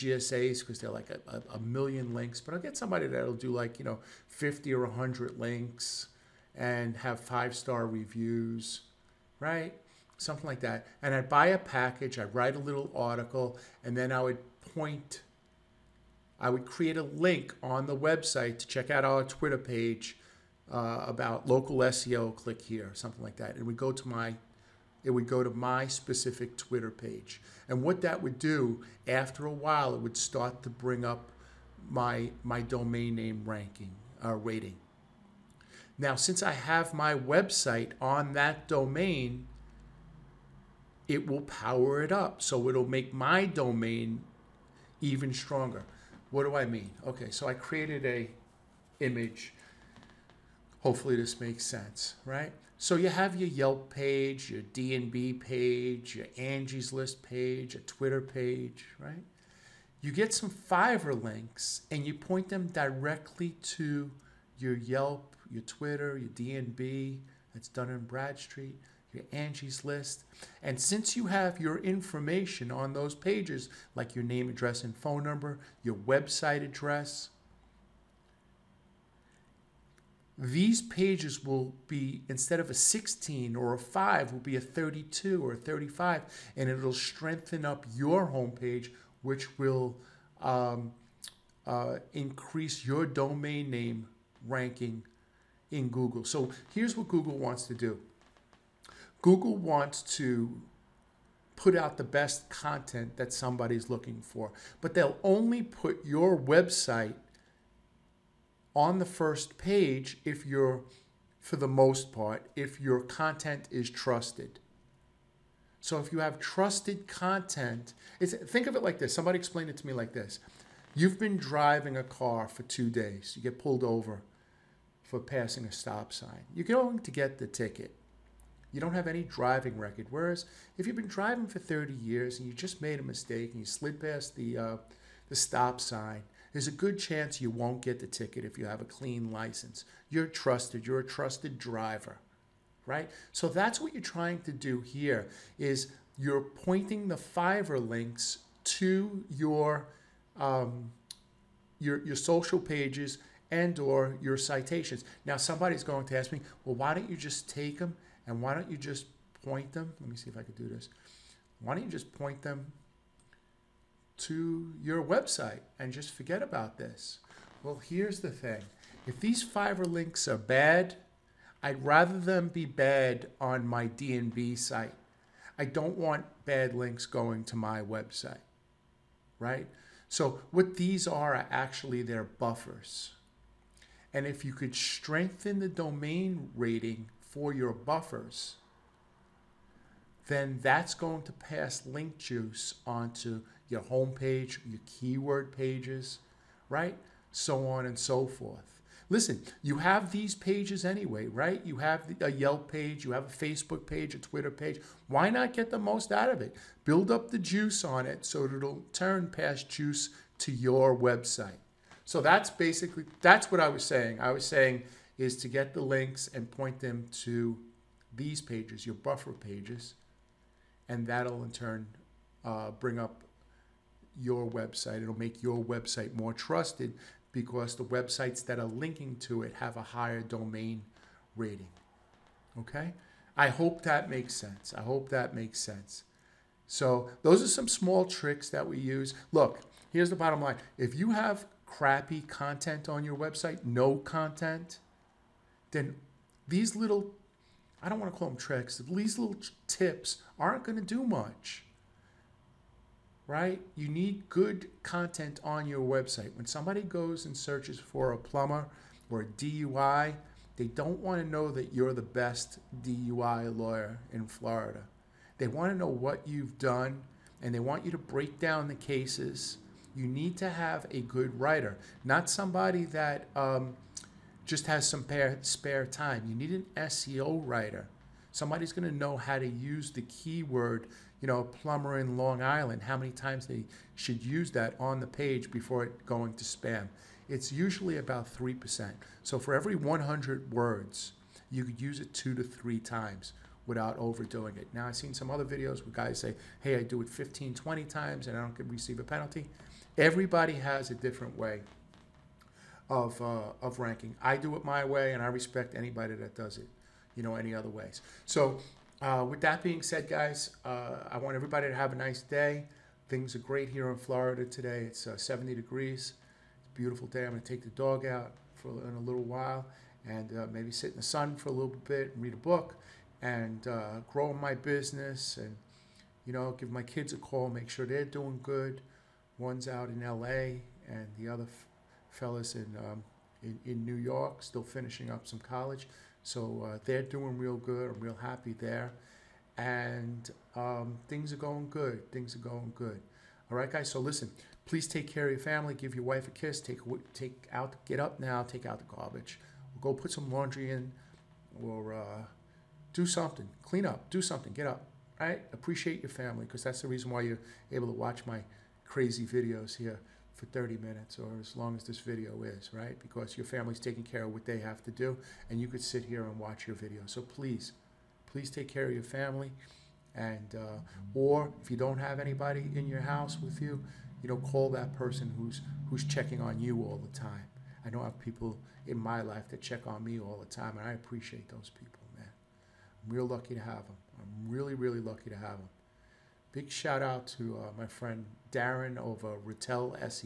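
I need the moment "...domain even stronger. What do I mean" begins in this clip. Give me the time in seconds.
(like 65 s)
43 s.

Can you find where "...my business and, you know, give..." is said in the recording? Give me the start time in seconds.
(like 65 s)
324 s.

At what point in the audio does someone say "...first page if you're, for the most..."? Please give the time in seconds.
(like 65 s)
109 s.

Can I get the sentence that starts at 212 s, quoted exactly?
So that's basically that's what I was saying.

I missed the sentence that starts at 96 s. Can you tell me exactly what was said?
So here's what Google wants to do.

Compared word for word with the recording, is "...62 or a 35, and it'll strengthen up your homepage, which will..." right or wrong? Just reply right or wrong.
wrong.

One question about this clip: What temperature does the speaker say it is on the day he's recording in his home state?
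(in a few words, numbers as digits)
70 degrees.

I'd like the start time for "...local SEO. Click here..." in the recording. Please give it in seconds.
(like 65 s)
21 s.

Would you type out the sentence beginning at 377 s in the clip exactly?
I know I have people in my life that check on me all the time and I appreciate those people, man.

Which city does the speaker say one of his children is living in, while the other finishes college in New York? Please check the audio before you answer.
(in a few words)
LA.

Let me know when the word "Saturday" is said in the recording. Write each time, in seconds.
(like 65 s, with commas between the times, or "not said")
not said.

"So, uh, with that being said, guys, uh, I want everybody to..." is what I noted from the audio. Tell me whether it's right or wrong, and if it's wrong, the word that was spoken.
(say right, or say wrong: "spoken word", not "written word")
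right.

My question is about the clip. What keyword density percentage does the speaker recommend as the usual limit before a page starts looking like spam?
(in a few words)
3%.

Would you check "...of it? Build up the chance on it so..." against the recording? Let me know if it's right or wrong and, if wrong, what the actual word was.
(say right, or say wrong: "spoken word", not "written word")
wrong: "juice", not "chance".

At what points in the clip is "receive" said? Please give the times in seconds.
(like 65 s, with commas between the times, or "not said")
298 s.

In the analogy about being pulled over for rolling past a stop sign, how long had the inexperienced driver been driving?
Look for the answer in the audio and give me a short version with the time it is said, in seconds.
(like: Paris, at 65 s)
two days, at 122 s.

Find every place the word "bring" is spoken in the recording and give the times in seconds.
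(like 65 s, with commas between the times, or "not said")
30 s, 222 s.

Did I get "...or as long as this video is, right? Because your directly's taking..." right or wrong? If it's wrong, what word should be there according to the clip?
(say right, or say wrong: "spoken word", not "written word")
wrong: "family", not "directly".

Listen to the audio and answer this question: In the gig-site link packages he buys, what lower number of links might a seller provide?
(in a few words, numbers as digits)
50.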